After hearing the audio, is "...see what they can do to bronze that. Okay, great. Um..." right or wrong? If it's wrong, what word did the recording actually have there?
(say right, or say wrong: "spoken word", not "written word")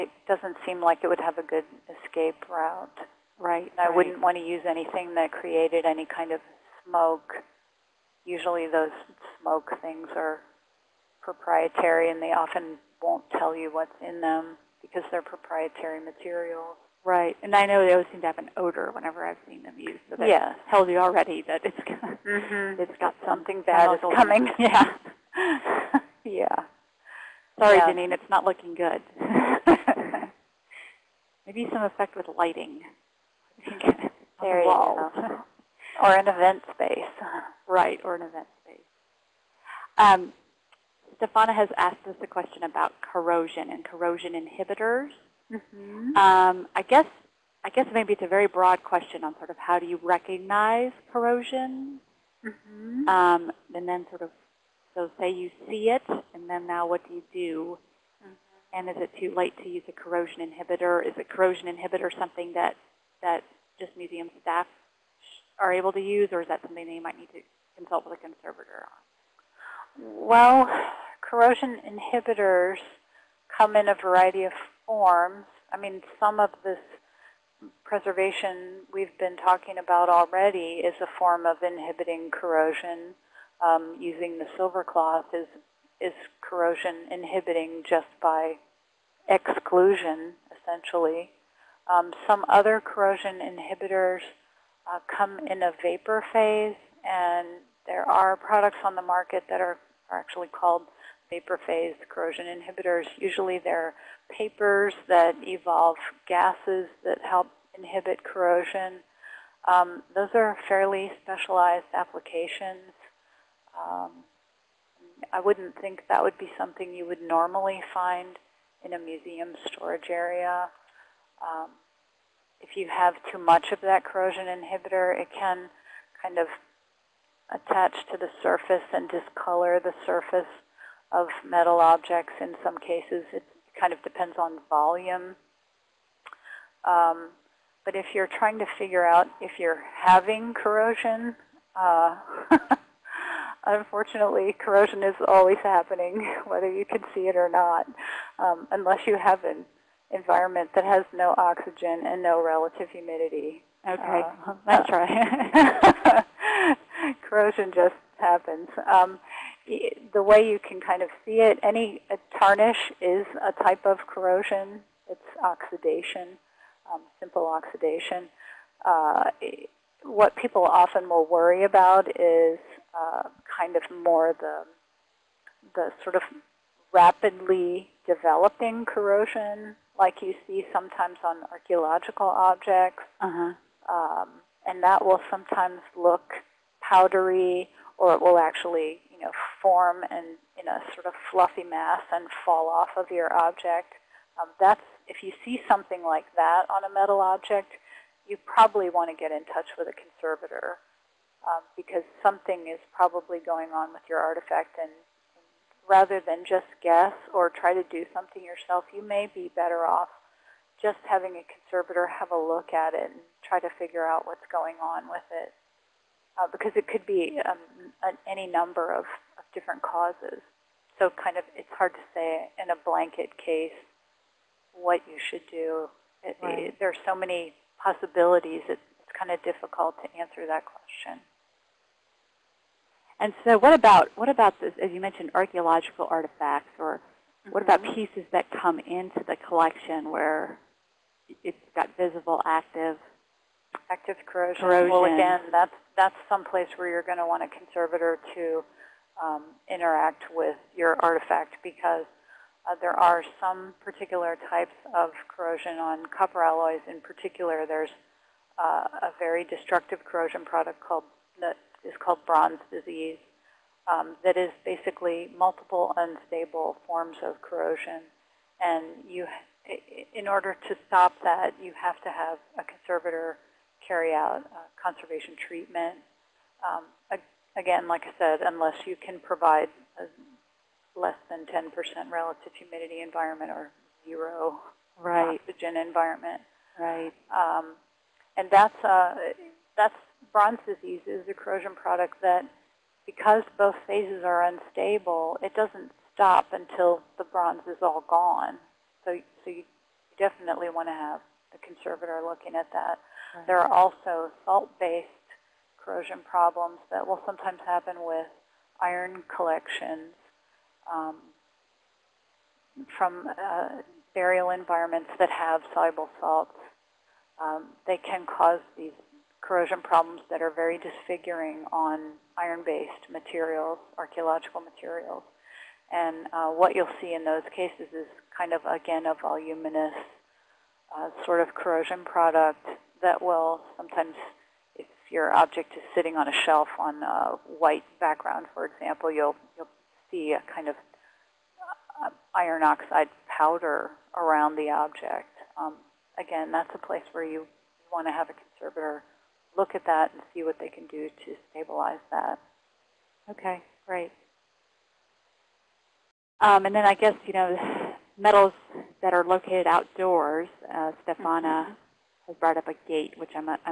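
wrong: "stabilize", not "bronze".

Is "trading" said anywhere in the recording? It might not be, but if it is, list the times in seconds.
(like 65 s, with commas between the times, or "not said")
not said.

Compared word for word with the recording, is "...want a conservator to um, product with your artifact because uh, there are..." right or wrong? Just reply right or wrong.
wrong.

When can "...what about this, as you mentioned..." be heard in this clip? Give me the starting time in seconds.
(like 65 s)
234 s.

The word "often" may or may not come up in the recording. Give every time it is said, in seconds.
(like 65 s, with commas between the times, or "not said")
12 s, 170 s.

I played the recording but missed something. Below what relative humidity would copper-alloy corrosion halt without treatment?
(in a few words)
10%.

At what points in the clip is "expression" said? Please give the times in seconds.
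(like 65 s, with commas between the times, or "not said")
not said.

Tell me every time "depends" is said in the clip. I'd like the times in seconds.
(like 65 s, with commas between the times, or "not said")
134 s.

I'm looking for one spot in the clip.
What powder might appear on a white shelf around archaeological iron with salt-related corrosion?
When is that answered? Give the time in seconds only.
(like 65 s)
342 s.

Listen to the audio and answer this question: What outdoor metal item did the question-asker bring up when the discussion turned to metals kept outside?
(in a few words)
A gate.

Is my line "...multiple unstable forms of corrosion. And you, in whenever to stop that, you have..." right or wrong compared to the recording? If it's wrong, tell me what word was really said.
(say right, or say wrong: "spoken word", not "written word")
wrong: "order", not "whenever".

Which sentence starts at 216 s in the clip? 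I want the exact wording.
Uh, because it could be um, an, any number of, of different causes.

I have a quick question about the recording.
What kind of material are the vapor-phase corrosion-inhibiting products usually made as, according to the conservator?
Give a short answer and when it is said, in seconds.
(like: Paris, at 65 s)
Papers, at 104 s.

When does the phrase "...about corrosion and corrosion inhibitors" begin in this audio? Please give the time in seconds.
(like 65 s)
42 s.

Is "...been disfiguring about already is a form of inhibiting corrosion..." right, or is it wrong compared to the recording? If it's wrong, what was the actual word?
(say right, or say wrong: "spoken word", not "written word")
wrong: "talking", not "disfiguring".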